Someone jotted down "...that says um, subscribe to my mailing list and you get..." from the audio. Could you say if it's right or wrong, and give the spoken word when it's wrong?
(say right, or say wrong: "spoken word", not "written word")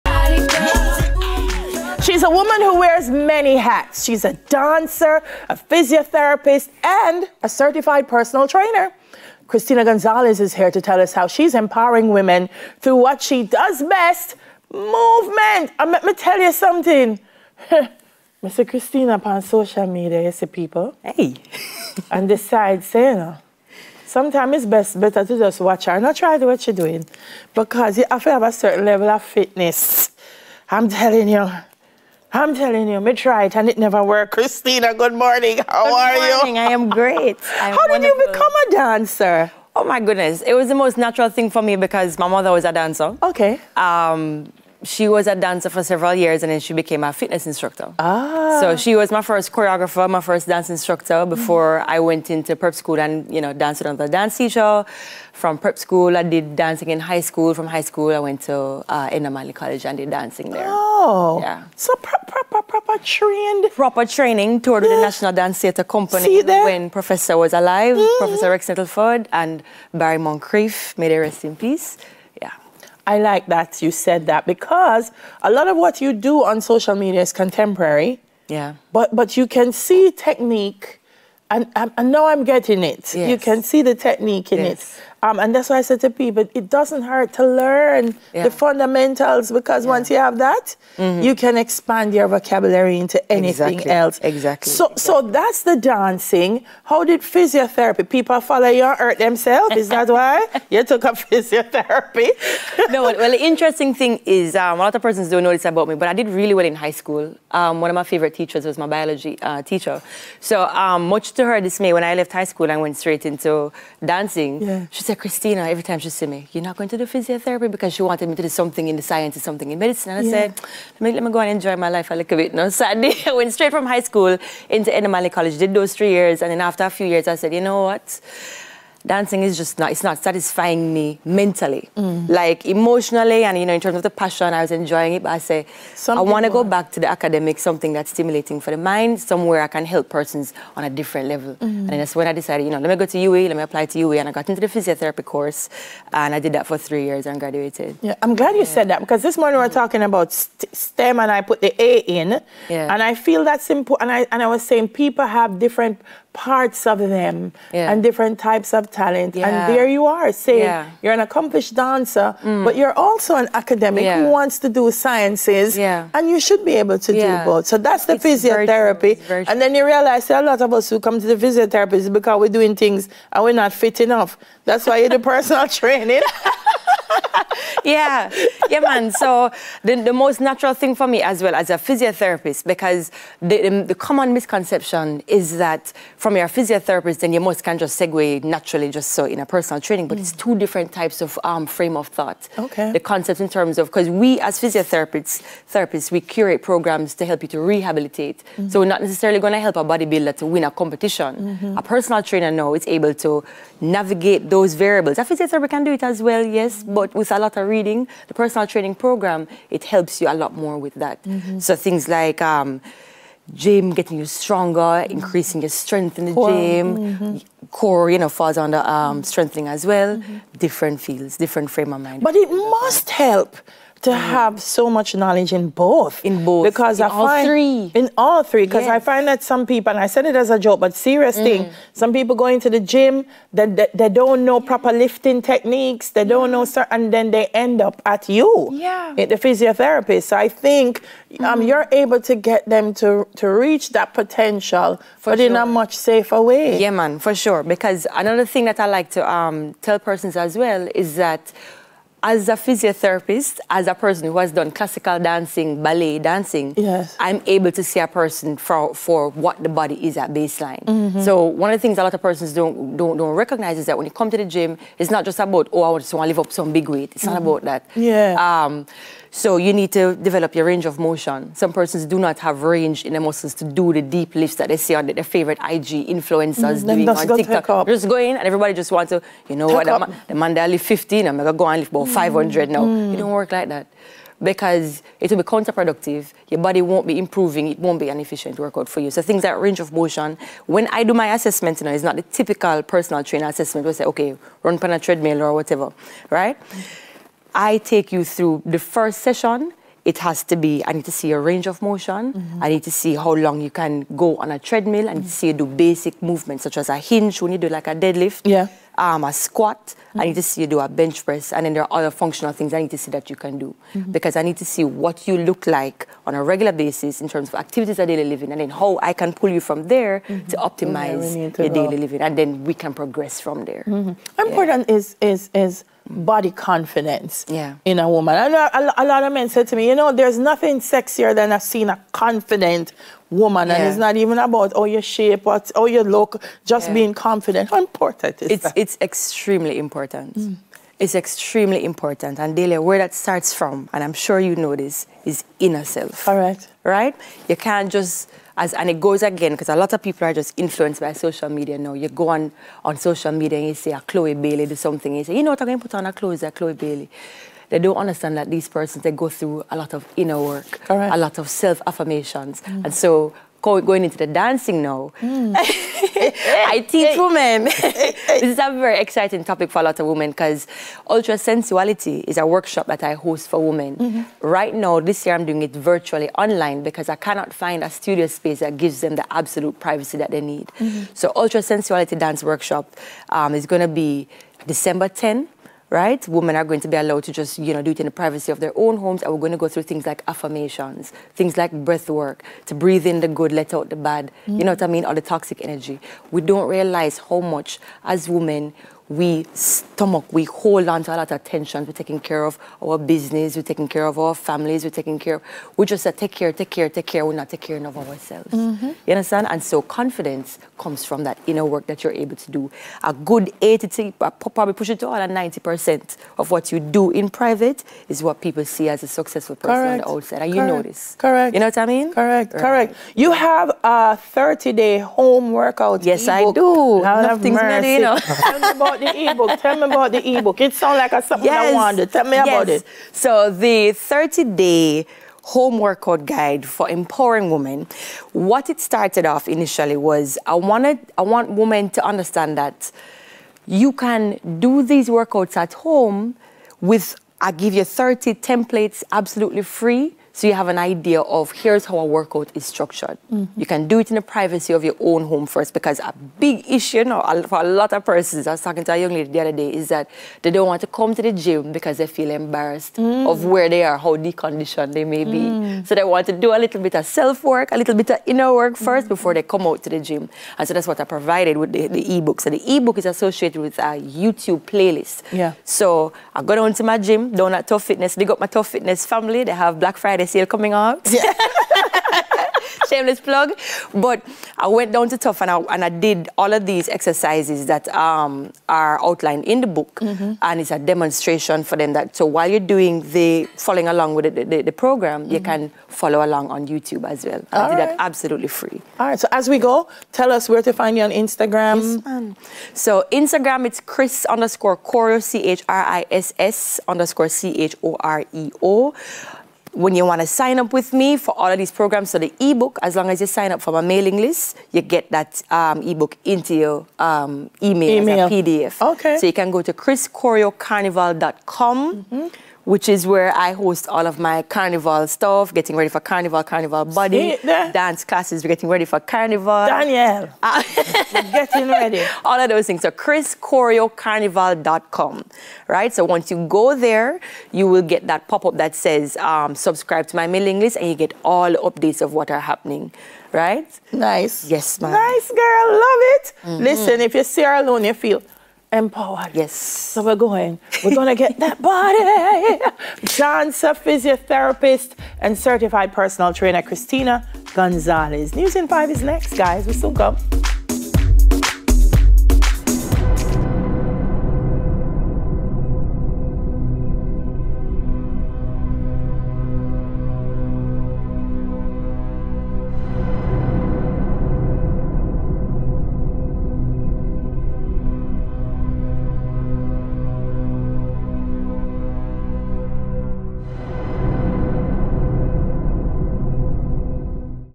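right.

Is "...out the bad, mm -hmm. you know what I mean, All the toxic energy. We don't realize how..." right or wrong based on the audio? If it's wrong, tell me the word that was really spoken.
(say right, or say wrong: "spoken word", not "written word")
right.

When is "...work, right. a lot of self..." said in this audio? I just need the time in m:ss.
6:00.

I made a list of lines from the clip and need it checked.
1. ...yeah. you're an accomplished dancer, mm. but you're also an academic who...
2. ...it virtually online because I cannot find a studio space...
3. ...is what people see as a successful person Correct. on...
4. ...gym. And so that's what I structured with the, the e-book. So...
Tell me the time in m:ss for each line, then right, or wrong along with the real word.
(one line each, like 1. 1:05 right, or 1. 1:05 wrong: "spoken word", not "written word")
1. 2:40 right
2. 6:15 right
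3. 6:58 right
4. 7:49 wrong: "provided", not "structured".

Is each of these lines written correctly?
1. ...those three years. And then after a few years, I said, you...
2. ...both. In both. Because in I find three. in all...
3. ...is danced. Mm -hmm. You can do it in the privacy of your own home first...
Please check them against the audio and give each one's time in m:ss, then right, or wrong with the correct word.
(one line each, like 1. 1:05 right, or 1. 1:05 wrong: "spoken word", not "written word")
1. 2:05 right
2. 3:45 right
3. 7:32 wrong: "structured", not "danced".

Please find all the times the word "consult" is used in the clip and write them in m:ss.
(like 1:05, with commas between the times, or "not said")
not said.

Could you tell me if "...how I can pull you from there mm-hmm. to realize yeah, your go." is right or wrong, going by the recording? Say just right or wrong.
wrong.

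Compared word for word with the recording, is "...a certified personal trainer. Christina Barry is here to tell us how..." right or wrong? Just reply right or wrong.
wrong.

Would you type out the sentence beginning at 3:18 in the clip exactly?
So we're not necessarily going to help a bodybuilder to win a competition.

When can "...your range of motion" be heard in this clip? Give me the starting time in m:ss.
4:30.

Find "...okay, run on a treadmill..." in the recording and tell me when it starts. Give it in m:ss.
4:54.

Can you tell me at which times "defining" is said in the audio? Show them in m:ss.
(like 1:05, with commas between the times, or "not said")
not said.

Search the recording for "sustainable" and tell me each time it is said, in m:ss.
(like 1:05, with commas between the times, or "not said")
not said.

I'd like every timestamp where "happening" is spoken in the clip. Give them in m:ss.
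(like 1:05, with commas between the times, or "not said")
9:02.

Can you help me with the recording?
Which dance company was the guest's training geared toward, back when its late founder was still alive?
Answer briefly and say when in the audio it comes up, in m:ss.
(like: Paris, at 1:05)
National Dance Theatre Company, at 1:05.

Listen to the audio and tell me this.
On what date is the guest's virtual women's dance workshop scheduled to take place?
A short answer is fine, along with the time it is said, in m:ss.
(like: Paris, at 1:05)
December 10, at 6:24.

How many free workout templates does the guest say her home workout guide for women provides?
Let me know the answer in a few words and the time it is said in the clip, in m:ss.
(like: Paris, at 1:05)
30, at 7:27.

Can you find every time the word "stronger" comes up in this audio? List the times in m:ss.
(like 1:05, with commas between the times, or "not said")
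3:34.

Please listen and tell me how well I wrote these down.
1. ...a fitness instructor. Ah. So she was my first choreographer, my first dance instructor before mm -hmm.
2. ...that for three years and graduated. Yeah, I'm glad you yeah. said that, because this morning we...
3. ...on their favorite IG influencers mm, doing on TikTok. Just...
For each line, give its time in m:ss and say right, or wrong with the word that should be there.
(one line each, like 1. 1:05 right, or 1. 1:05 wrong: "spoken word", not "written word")
1. 0:47 right
2. 2:26 right
3. 4:34 right.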